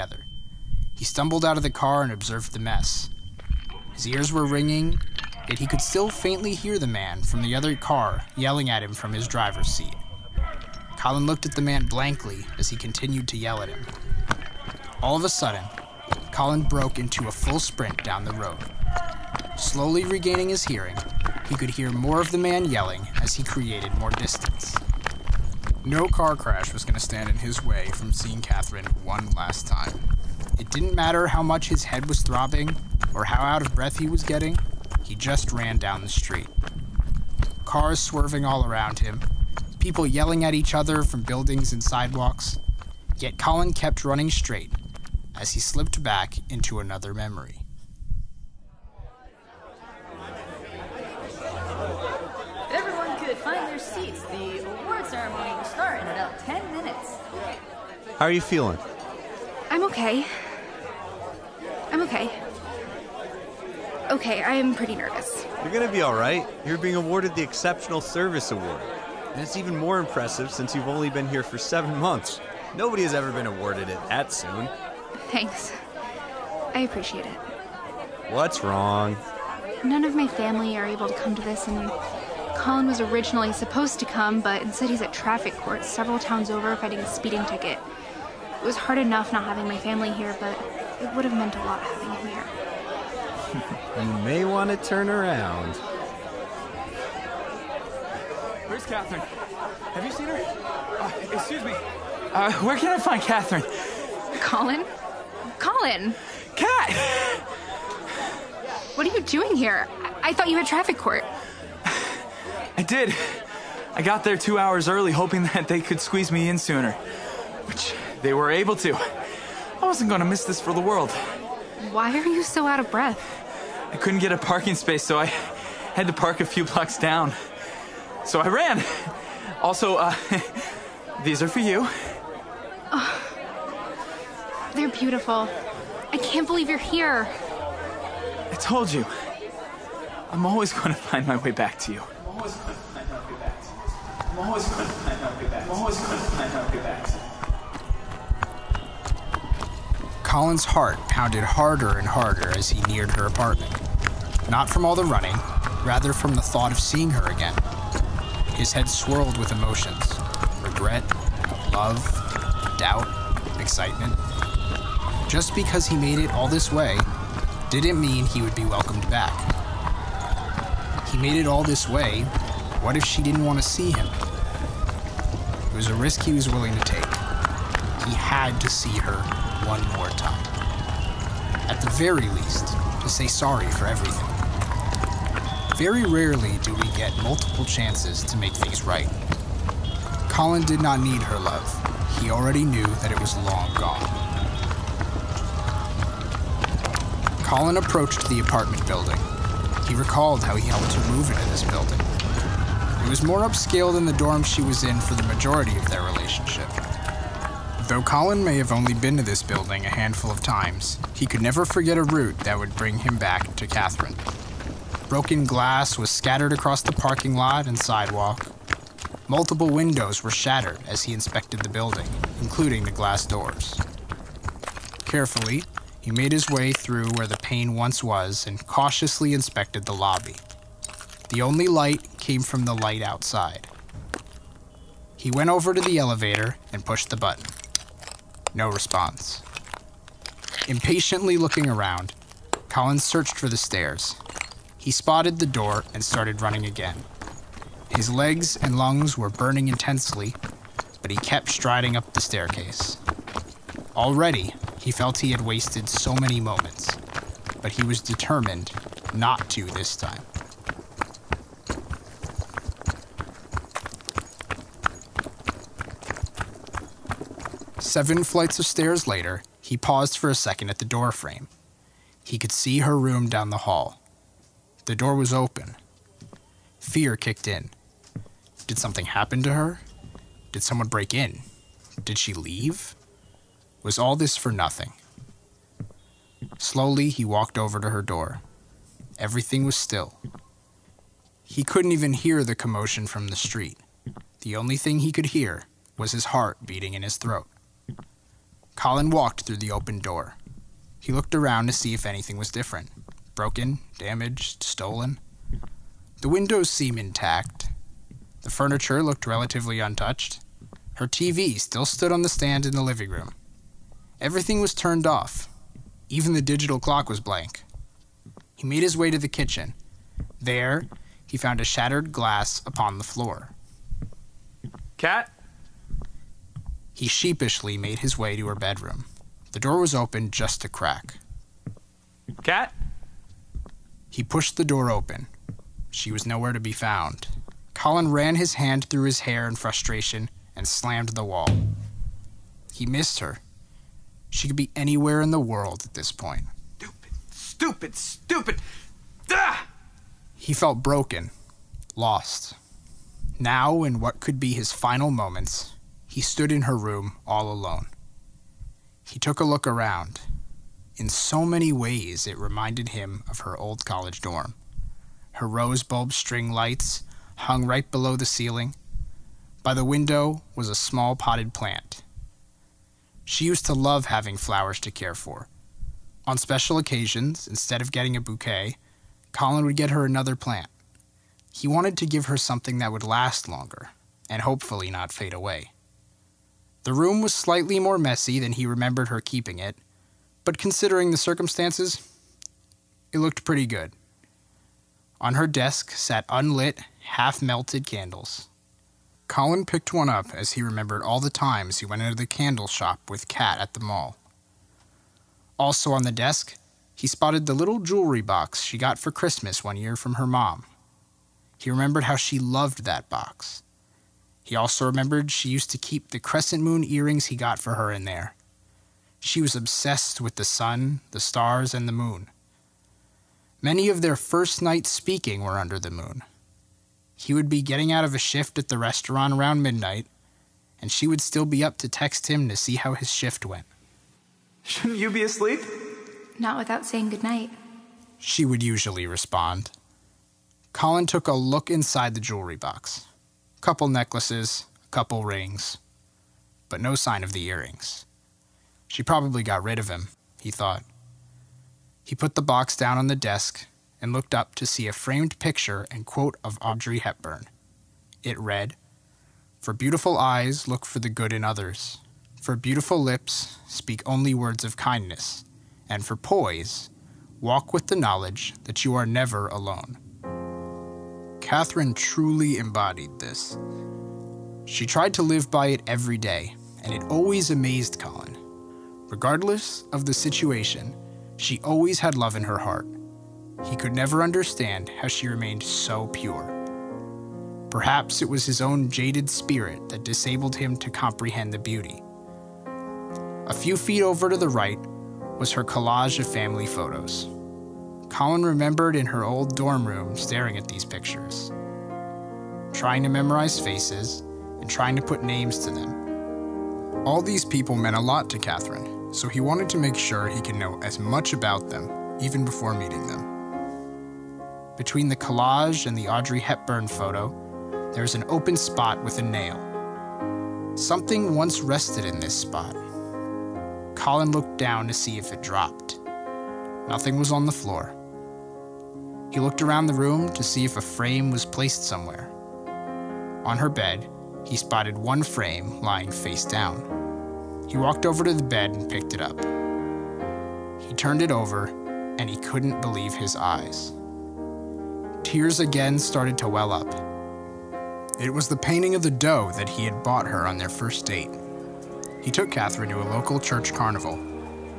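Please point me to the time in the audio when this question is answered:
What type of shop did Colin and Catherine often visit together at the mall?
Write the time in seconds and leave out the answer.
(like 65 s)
402 s.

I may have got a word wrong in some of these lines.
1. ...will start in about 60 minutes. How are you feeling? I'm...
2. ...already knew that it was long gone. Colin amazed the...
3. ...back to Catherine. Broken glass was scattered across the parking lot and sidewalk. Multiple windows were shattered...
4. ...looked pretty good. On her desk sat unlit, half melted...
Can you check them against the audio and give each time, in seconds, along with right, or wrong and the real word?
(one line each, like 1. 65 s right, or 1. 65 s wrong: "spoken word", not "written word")
1. 55 s wrong: "10", not "60"
2. 192 s wrong: "approached", not "amazed"
3. 213 s right
4. 393 s right.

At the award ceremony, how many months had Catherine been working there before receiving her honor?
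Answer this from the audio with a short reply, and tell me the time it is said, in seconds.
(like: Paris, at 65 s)
7, at 71 s.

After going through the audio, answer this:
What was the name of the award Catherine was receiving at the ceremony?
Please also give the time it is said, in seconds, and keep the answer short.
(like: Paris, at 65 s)
Exceptional Service Award, at 67 s.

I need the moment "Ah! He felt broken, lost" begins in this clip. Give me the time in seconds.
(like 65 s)
349 s.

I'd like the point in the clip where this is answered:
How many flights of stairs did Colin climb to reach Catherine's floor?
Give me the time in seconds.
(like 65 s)
267 s.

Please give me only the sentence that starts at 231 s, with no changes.
The only light came from the light outside.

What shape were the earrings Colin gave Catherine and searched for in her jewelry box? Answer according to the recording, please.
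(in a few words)
Crescent moon.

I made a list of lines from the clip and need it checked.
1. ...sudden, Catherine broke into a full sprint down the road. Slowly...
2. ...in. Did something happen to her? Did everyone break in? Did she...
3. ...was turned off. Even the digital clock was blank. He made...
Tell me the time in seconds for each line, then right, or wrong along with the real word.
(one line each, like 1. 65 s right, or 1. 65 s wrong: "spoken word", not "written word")
1. 15 s wrong: "Colin", not "Catherine"
2. 277 s wrong: "someone", not "everyone"
3. 314 s right.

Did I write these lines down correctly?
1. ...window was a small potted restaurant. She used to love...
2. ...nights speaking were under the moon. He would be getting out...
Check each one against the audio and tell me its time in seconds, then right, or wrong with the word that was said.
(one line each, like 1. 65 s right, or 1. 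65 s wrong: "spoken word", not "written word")
1. 369 s wrong: "plant", not "restaurant"
2. 424 s right.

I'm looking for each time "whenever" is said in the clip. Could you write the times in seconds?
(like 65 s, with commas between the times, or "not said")
not said.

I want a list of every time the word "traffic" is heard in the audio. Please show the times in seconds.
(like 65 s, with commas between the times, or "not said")
85 s, 110 s.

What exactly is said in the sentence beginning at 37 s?
Cars swerving all around him, people yelling at each other from buildings and sidewalks.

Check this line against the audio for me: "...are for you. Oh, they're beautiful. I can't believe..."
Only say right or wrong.
right.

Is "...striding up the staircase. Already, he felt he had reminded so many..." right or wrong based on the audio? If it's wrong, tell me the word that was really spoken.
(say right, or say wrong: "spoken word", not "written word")
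wrong: "wasted", not "reminded".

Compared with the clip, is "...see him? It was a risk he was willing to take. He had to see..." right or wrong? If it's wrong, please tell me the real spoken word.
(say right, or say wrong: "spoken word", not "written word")
right.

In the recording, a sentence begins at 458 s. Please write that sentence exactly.
It read, For beautiful eyes, look for the good in others.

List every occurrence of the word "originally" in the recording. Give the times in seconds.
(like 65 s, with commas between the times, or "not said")
83 s.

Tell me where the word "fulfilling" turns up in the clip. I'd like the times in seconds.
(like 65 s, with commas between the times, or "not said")
not said.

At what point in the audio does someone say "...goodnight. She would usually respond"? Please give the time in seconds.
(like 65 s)
437 s.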